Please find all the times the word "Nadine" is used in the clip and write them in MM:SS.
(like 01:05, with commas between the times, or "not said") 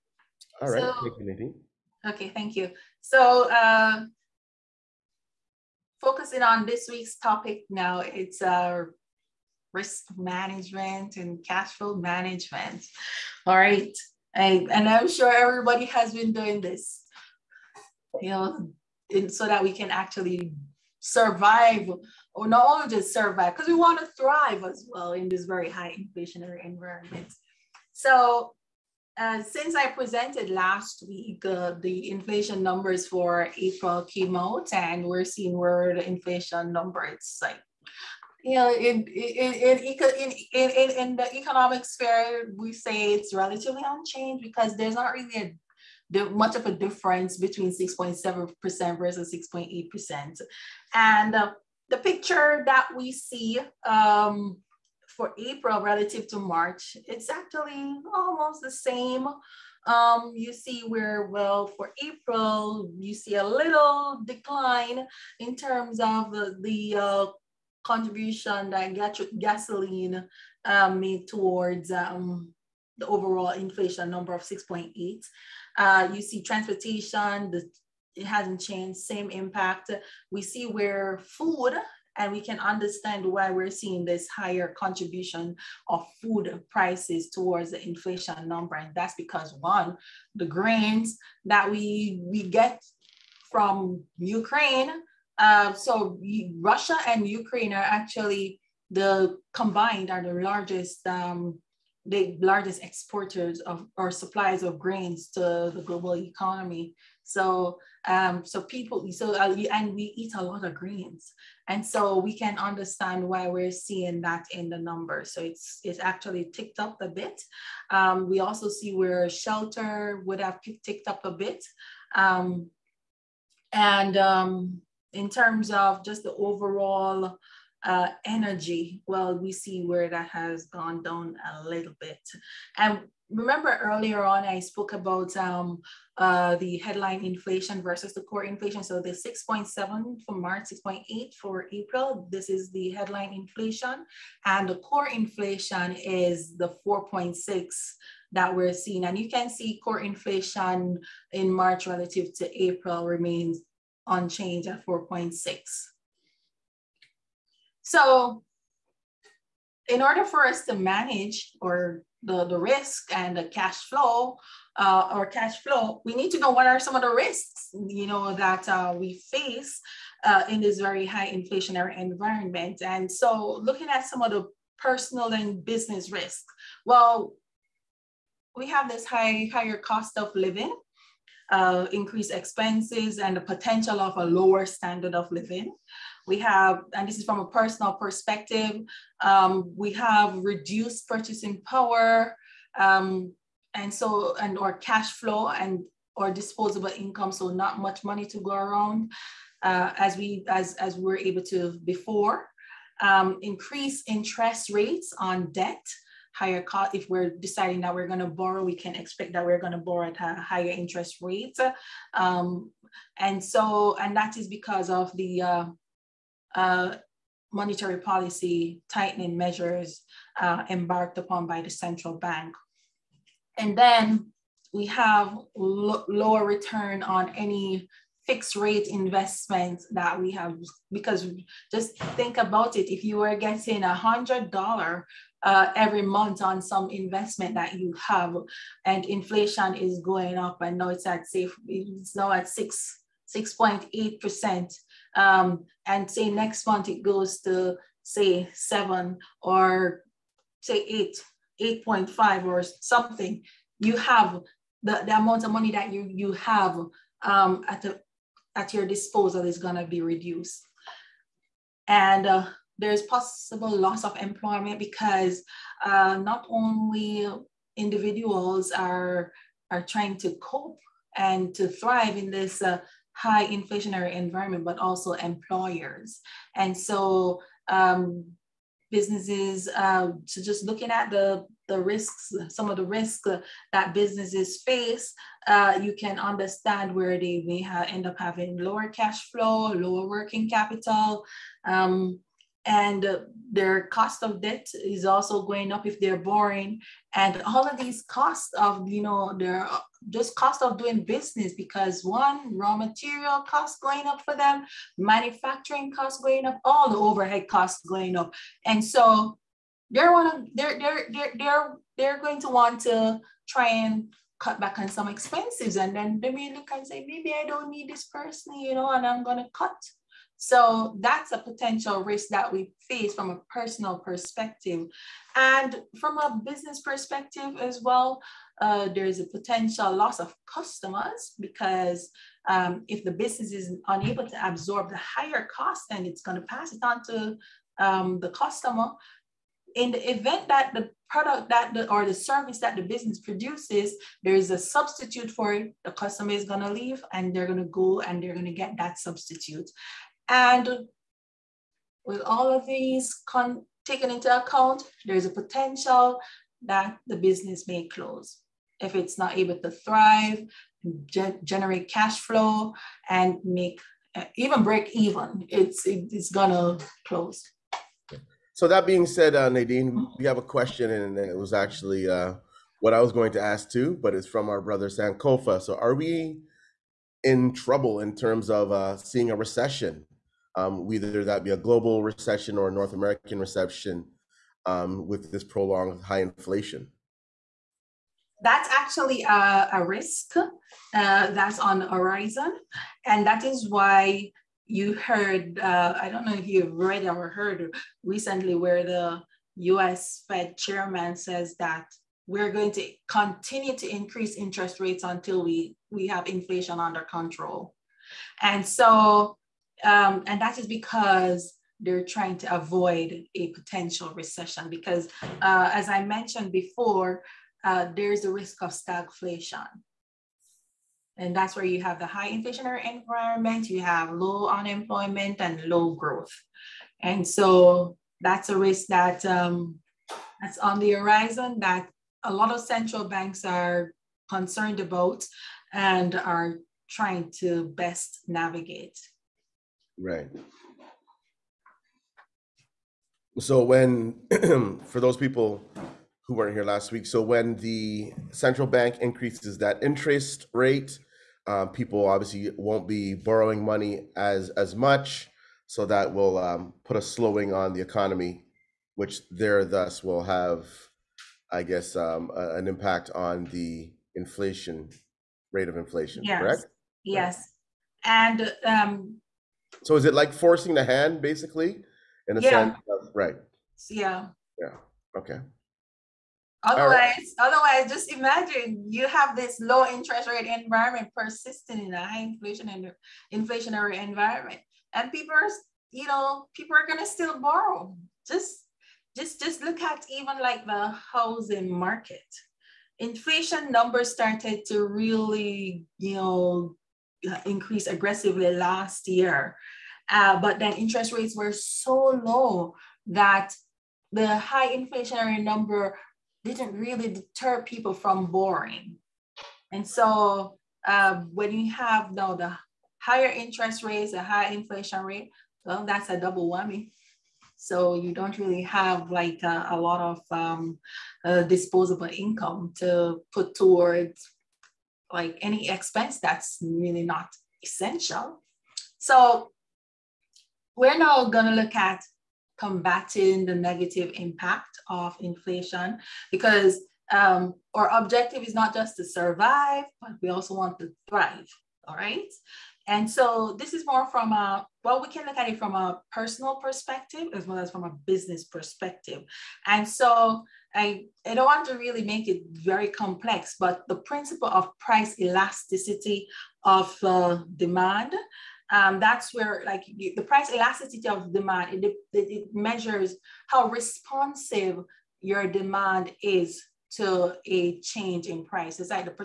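00:01, 06:09.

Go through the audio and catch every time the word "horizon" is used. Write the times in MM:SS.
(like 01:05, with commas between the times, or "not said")
06:31, 07:10.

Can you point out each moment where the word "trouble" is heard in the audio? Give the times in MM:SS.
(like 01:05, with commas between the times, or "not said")
06:17.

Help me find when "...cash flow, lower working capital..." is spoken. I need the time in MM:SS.
04:48.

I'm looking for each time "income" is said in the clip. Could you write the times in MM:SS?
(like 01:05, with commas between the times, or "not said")
03:16, 08:42.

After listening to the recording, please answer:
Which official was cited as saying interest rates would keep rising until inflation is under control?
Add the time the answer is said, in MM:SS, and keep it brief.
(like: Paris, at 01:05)
US Fed chairman, at 06:39.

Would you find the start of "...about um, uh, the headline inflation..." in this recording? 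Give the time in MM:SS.
02:14.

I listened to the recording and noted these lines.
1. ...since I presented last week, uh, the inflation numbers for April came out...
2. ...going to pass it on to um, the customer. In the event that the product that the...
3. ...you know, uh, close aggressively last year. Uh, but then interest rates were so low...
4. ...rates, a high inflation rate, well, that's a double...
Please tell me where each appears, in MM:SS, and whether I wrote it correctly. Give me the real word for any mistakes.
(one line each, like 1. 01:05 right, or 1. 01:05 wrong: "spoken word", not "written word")
1. 00:29 right
2. 05:36 right
3. 08:15 wrong: "increase", not "close"
4. 08:33 right.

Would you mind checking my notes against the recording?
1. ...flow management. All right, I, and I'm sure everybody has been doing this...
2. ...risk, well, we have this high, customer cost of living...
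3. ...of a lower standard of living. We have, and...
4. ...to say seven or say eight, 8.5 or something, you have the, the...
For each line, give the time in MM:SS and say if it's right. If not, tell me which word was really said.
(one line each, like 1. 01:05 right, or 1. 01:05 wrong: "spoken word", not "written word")
1. 00:11 right
2. 02:56 wrong: "higher", not "customer"
3. 03:03 right
4. 04:07 right.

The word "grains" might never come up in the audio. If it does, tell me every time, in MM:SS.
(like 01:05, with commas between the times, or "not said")
01:30, 01:44.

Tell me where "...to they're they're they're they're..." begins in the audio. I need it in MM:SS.
05:10.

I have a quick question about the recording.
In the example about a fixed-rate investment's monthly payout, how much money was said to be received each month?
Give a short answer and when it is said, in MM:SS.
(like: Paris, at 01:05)
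100 dollars, at 03:53.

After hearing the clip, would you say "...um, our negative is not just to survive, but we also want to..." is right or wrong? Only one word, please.
wrong.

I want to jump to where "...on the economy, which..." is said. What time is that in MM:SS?
07:37.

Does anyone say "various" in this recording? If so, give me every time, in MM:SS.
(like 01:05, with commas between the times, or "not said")
not said.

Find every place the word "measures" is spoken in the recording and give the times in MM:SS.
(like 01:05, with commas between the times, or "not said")
03:39, 09:22.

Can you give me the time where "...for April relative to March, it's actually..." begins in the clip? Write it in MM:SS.
00:55.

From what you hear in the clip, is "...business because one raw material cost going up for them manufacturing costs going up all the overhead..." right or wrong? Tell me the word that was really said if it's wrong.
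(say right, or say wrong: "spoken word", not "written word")
right.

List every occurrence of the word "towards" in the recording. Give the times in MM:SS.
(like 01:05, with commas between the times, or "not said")
01:11, 01:27, 08:43.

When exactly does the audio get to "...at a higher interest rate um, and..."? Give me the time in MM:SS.
03:30.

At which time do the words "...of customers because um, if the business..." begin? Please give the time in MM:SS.
05:30.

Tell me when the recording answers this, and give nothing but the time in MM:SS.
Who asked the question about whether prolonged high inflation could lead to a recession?
06:14.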